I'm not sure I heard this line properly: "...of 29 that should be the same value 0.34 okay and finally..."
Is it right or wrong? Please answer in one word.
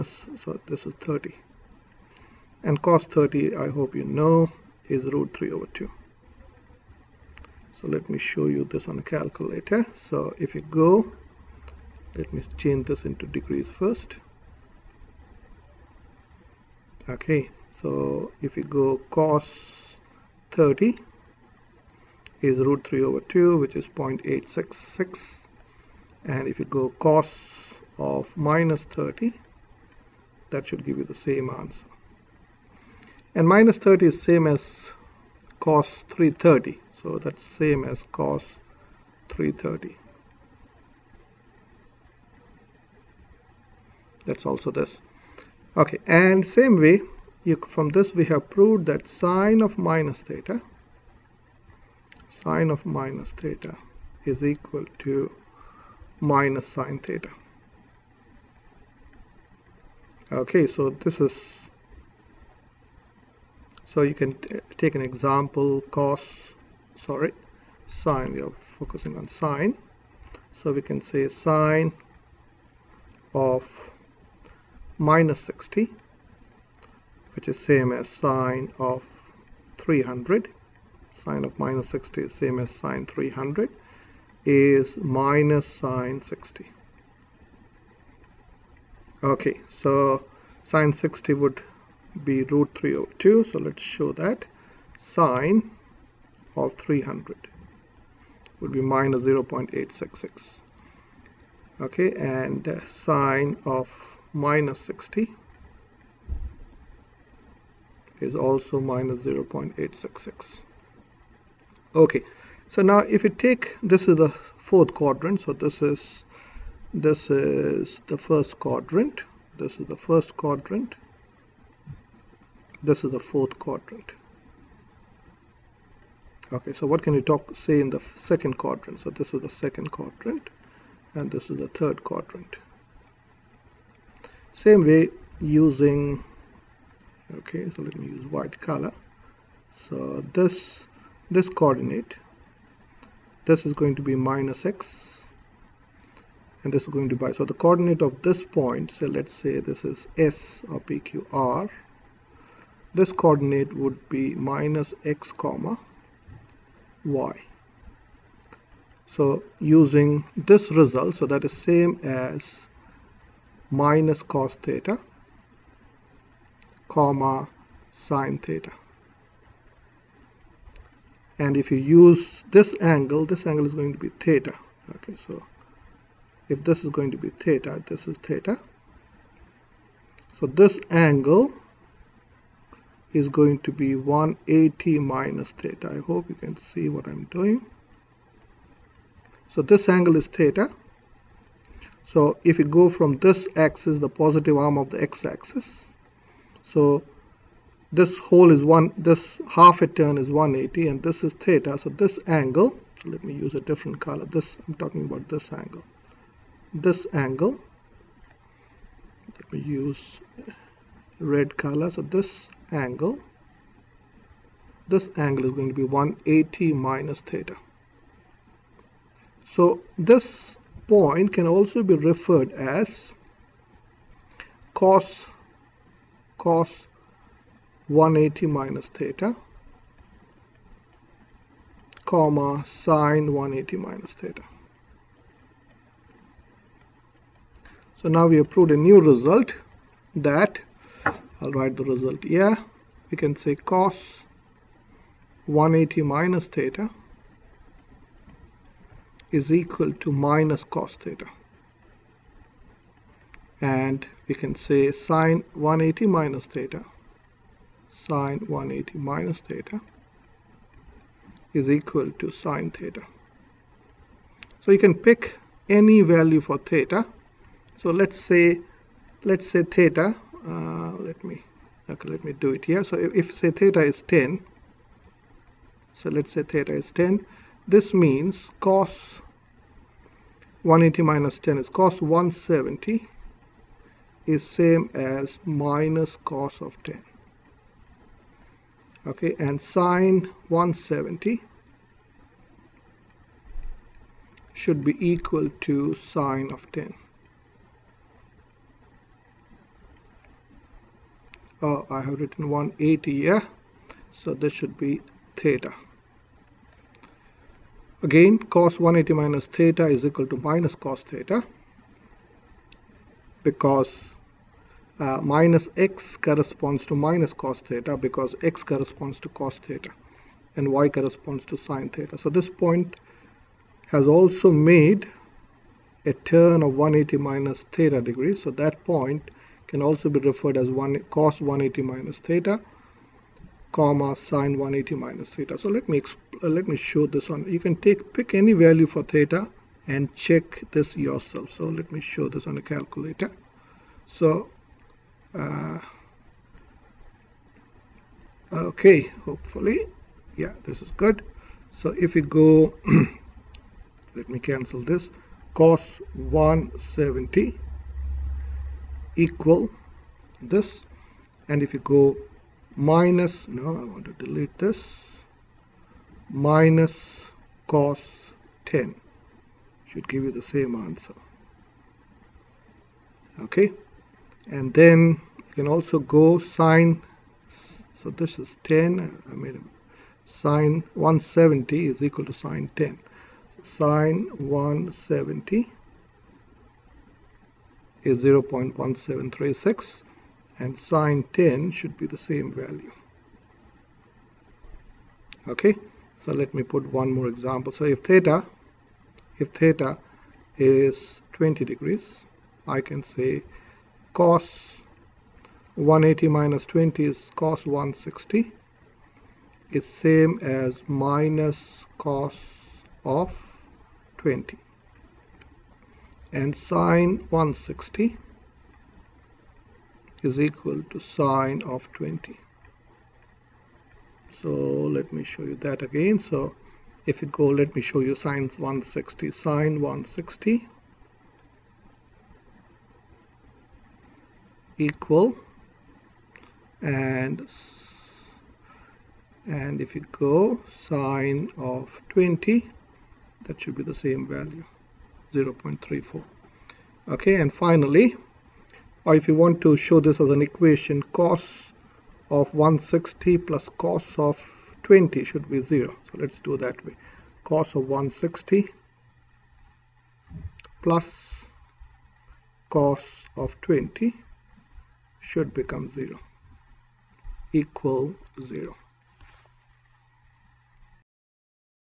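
wrong.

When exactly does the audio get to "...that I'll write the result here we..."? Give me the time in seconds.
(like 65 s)
240 s.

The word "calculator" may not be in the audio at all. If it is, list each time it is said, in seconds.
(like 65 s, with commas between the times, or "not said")
9 s, 342 s.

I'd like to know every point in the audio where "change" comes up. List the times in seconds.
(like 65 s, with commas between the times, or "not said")
12 s.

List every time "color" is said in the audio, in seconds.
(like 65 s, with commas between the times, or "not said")
138 s, 203 s, 211 s.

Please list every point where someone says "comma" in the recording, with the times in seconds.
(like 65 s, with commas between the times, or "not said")
155 s, 166 s, 232 s, 333 s.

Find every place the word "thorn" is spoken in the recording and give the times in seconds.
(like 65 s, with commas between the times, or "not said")
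not said.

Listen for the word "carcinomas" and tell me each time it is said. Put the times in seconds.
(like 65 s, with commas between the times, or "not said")
not said.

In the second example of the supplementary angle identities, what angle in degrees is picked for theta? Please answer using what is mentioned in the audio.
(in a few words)
20 degrees.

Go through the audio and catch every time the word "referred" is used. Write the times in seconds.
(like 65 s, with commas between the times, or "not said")
221 s, 330 s.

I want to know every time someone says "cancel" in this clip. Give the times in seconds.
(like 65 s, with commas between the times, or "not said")
354 s.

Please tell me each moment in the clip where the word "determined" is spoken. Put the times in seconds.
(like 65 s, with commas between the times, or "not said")
not said.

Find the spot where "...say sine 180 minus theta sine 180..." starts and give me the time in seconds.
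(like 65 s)
254 s.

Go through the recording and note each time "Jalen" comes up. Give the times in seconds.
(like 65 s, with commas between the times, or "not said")
not said.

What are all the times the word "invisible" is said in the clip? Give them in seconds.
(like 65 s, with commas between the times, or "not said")
not said.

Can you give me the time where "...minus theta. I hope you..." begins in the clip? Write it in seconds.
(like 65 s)
184 s.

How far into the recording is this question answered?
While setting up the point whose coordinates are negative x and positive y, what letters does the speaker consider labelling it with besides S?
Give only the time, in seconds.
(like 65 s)
150 s.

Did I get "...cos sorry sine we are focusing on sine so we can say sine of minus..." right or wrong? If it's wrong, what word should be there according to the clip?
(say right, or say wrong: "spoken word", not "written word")
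right.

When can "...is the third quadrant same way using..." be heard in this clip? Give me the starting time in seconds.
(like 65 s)
131 s.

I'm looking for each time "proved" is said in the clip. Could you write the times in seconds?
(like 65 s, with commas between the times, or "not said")
48 s, 238 s.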